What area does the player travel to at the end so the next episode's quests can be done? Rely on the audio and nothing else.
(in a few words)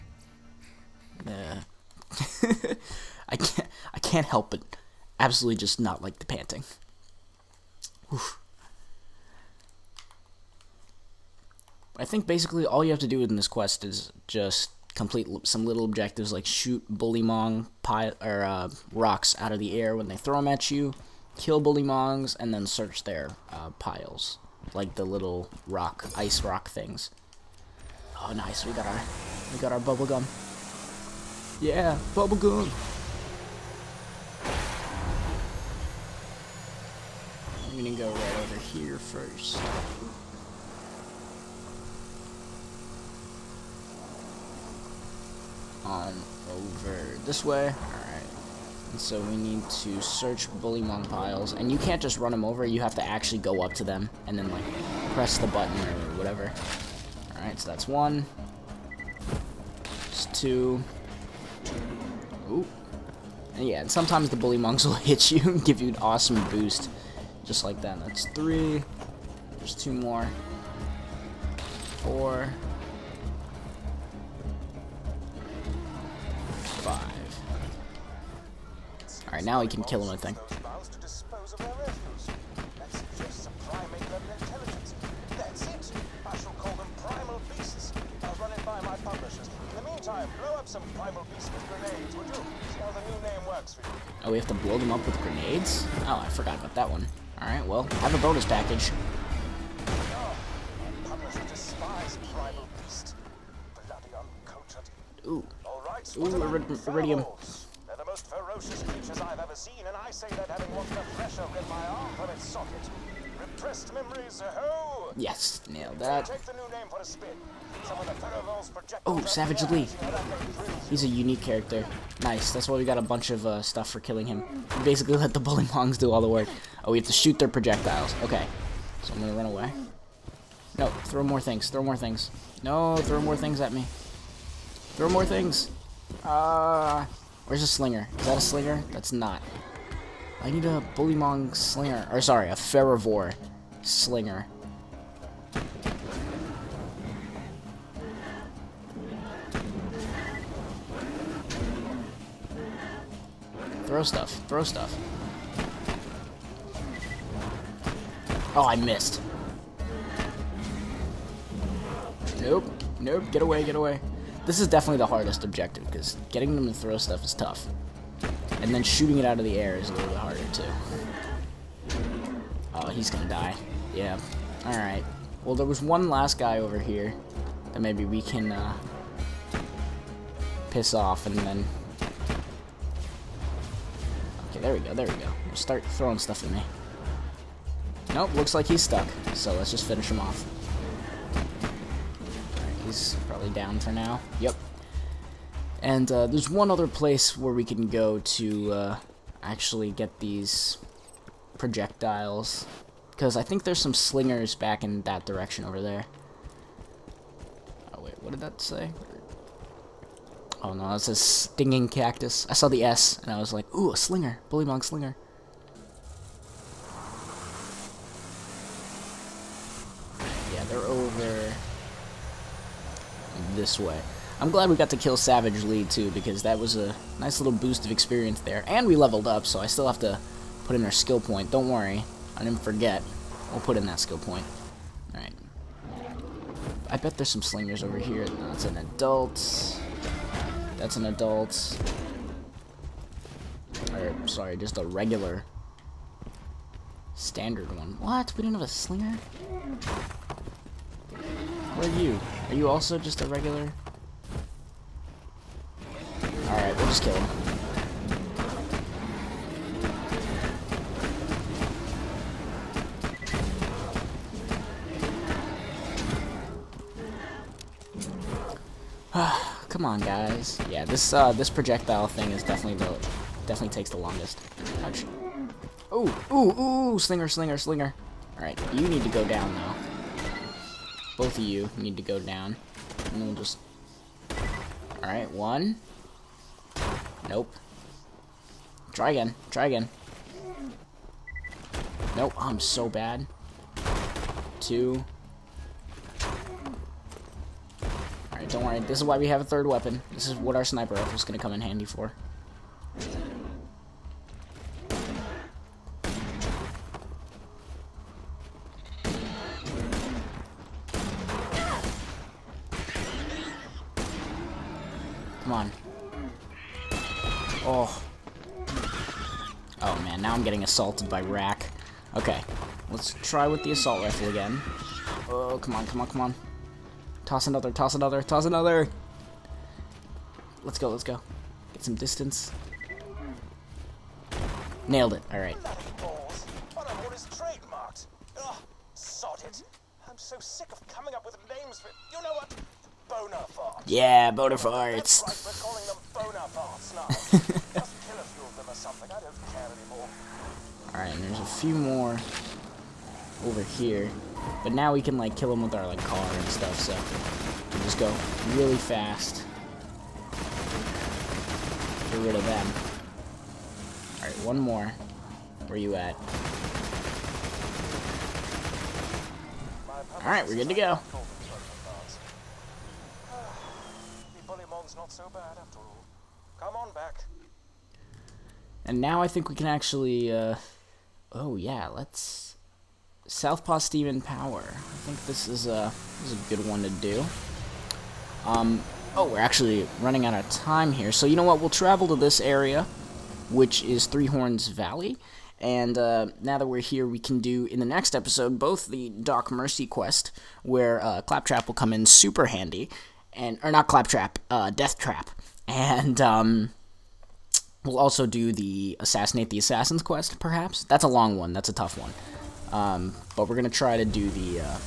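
Three Horns Valley.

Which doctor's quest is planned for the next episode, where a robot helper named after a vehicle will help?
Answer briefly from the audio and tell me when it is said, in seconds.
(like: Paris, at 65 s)
Doc Mercy, at 399 s.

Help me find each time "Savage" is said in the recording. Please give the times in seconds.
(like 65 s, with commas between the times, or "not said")
119 s, 225 s.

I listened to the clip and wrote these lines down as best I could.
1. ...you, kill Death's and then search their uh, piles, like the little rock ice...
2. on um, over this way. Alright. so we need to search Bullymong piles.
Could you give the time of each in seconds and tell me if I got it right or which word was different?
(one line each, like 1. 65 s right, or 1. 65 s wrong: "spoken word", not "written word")
1. 20 s wrong: "Bullymong", not "Death"
2. 45 s right.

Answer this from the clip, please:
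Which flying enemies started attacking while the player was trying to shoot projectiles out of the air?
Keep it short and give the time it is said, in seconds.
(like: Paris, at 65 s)
Rakk, at 321 s.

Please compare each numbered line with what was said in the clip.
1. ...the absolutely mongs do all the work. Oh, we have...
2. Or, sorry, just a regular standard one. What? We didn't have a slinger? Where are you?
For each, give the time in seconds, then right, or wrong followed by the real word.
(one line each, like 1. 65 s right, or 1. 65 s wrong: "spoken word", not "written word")
1. 125 s wrong: "bully", not "absolutely"
2. 243 s right.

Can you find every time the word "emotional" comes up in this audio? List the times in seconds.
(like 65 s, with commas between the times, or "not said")
not said.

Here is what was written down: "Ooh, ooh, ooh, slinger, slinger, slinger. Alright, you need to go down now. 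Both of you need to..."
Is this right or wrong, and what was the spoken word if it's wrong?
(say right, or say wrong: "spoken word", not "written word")
right.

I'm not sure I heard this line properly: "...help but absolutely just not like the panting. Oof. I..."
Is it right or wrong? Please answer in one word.
right.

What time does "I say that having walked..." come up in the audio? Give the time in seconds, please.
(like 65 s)
110 s.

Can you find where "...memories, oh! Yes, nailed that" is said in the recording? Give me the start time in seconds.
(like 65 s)
113 s.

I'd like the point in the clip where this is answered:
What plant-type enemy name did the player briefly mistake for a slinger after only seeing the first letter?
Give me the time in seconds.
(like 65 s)
211 s.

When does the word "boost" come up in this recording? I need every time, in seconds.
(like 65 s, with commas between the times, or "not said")
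66 s, 227 s.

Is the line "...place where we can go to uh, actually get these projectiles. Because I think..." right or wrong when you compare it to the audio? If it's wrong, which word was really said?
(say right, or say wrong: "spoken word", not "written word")
right.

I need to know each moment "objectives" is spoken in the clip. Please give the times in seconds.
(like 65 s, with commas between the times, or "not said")
15 s, 165 s.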